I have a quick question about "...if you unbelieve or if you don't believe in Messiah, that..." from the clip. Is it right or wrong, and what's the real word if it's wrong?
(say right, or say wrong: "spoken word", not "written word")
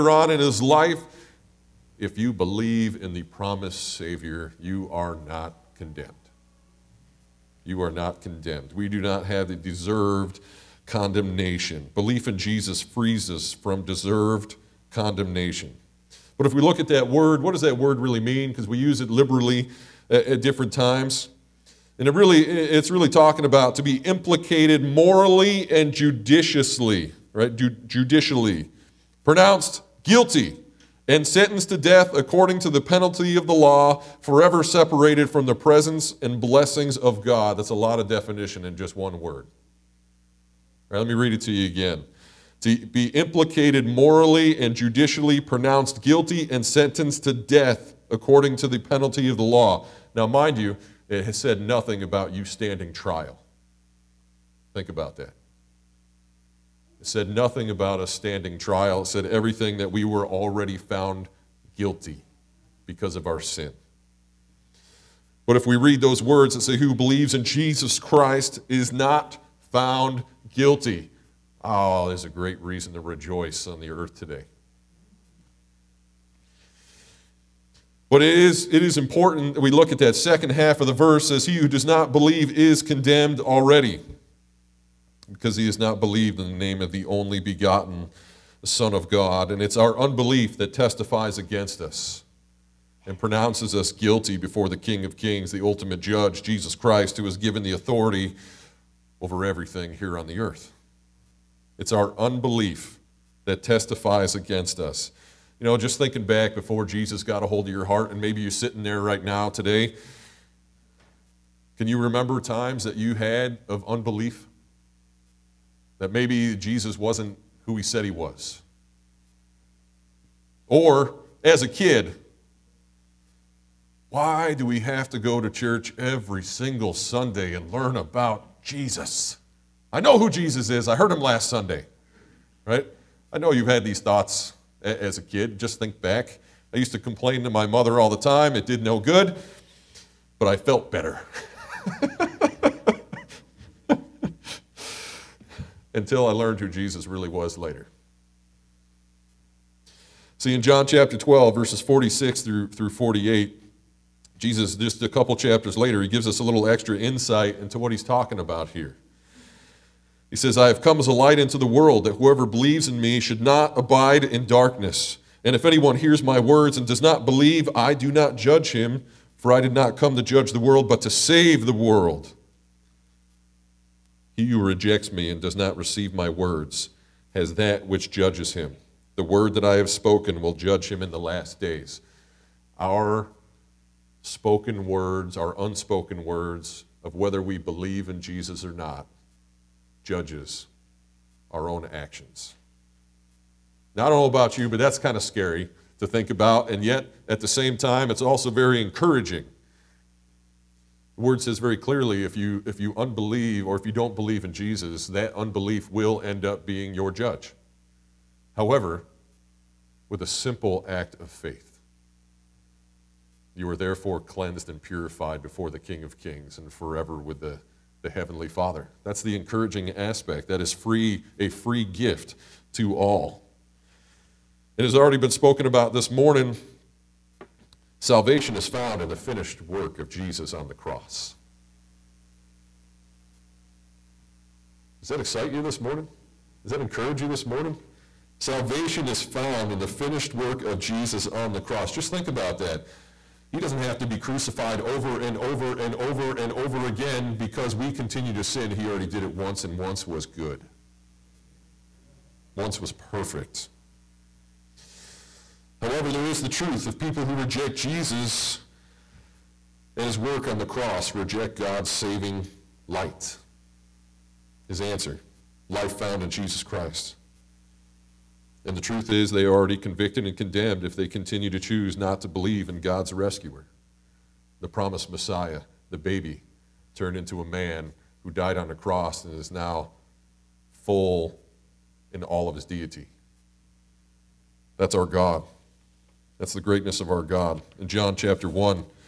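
wrong: "Jesus", not "Messiah".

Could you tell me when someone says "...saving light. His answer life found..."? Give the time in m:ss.
4:21.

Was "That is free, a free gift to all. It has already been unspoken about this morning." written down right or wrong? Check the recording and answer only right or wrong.
wrong.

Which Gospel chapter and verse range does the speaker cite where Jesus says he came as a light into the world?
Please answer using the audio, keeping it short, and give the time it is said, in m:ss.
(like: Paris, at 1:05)
John 12:46-48, at 2:30.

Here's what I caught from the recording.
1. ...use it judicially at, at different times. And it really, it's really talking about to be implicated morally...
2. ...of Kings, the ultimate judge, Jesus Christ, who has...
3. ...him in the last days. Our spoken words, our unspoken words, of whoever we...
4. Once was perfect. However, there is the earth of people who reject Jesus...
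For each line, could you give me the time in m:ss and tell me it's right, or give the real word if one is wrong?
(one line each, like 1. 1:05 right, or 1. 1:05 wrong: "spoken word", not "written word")
1. 0:18 wrong: "liberally", not "judicially"
2. 1:35 right
3. 3:00 wrong: "whether", not "whoever"
4. 4:12 wrong: "truth", not "earth".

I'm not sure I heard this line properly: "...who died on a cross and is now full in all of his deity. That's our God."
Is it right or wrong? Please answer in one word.
right.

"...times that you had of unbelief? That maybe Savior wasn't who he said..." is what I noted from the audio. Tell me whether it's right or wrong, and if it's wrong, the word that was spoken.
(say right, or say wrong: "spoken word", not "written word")
wrong: "Jesus", not "Savior".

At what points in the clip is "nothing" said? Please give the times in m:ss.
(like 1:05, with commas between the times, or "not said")
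0:51, 0:57.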